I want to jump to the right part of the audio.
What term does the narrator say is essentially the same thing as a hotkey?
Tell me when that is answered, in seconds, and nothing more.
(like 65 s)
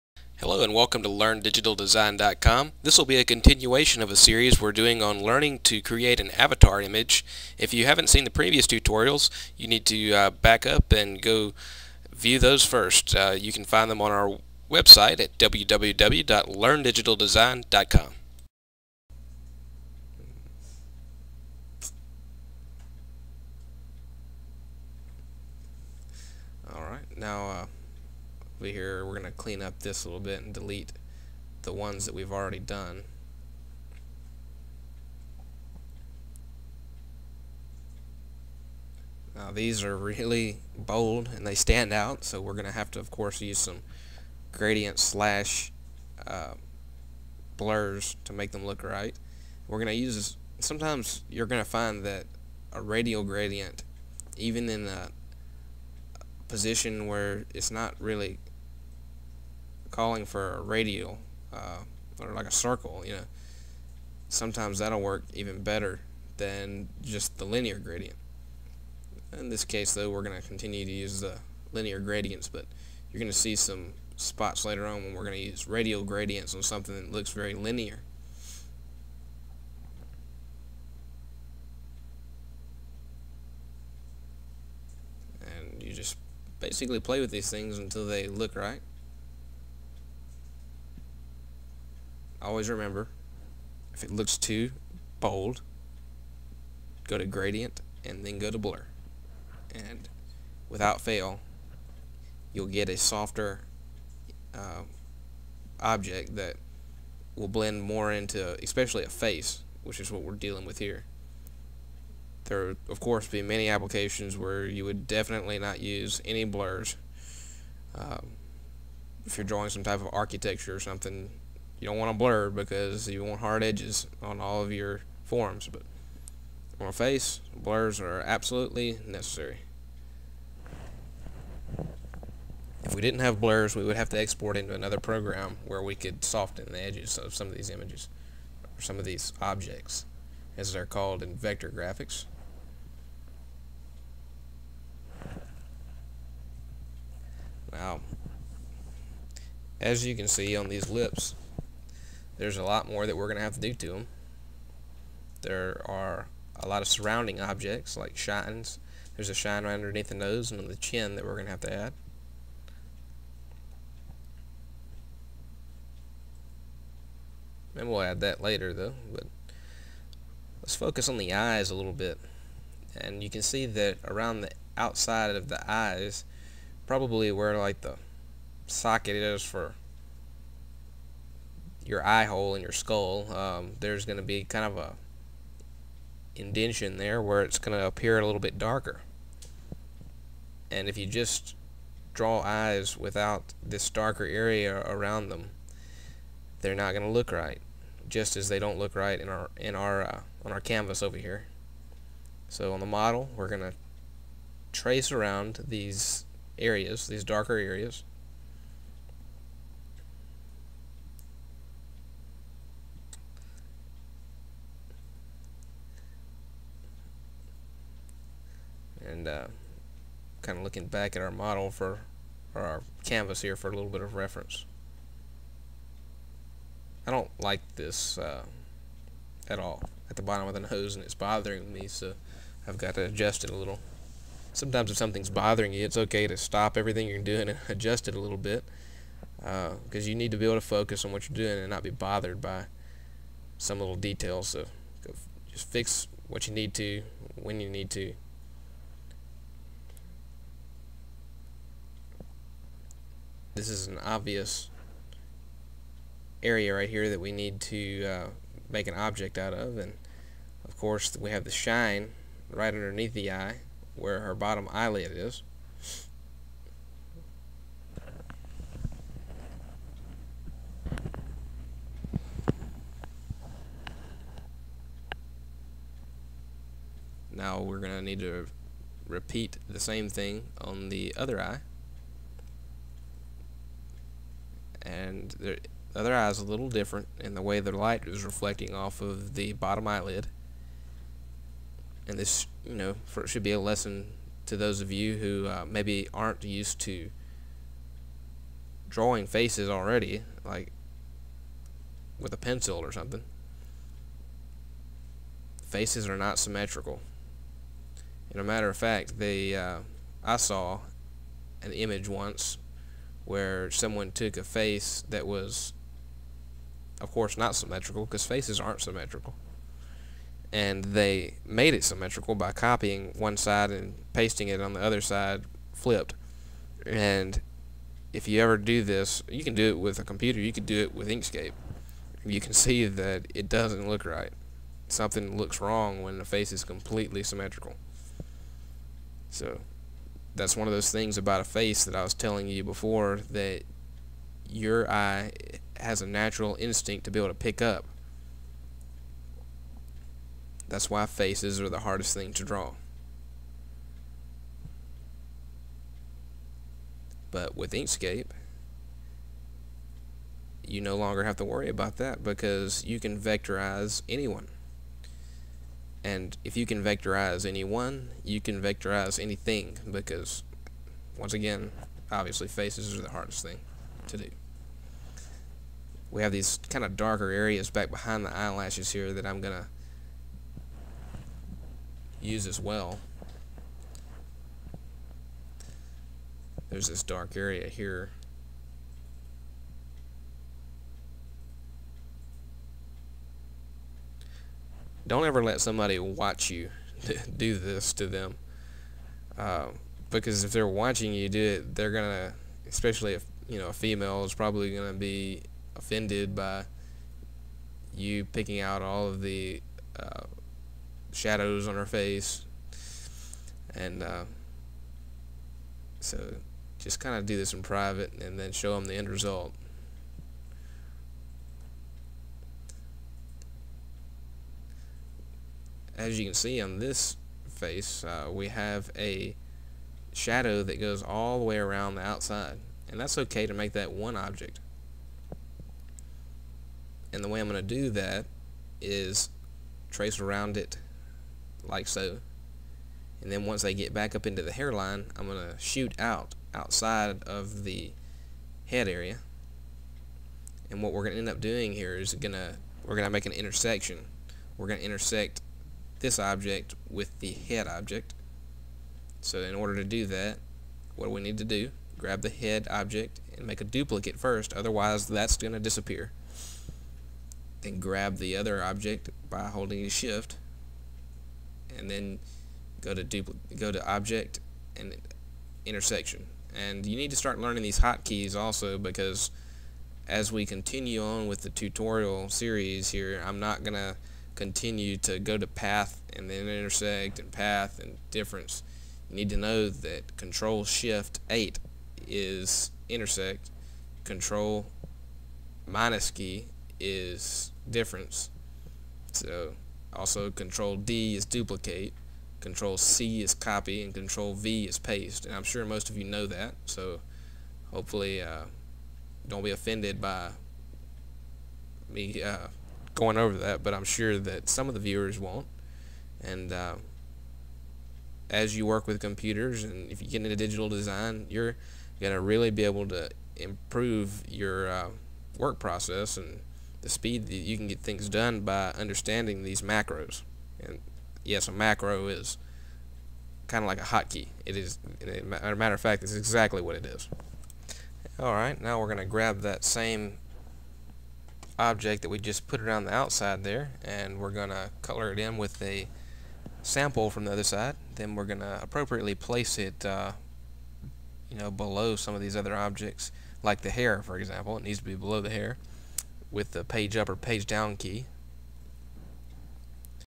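531 s.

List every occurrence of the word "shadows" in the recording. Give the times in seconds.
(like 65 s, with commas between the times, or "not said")
411 s, 430 s.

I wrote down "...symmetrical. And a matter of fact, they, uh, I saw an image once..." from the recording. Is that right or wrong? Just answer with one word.
right.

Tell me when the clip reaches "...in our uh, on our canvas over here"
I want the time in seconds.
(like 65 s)
199 s.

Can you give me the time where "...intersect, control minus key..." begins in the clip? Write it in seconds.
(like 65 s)
492 s.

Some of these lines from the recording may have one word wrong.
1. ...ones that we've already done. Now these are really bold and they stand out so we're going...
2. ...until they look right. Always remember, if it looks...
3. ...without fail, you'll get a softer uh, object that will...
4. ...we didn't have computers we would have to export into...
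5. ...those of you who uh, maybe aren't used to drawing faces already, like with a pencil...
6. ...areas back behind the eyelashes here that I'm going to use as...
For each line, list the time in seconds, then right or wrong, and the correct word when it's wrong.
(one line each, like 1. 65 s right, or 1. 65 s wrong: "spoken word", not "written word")
1. 31 s right
2. 87 s right
3. 100 s right
4. 132 s wrong: "blurs", not "computers"
5. 294 s right
6. 377 s right.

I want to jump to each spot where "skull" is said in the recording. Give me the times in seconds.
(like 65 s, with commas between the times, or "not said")
182 s.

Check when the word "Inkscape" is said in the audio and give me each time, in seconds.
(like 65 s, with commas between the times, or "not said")
331 s, 357 s.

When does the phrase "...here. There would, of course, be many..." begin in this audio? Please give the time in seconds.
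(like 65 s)
110 s.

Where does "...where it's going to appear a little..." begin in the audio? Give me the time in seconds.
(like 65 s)
187 s.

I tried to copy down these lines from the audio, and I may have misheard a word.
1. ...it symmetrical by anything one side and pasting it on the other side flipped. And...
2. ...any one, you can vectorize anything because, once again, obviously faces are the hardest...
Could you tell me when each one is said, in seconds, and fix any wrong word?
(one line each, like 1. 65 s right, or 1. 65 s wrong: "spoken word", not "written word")
1. 321 s wrong: "copying", not "anything"
2. 367 s right.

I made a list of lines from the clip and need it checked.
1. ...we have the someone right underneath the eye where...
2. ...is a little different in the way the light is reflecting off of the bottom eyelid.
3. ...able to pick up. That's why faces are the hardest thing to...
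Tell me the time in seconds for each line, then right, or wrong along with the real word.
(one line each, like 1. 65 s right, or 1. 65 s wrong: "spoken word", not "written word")
1. 261 s wrong: "shine", not "someone"
2. 286 s right
3. 347 s right.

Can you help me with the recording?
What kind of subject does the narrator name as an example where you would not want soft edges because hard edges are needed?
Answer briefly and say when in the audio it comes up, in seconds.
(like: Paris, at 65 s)
architecture, at 120 s.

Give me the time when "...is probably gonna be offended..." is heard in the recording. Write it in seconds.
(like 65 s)
404 s.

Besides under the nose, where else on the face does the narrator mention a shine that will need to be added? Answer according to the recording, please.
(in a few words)
chin.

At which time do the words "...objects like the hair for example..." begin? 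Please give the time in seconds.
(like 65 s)
552 s.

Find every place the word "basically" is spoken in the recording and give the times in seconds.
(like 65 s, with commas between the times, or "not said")
86 s.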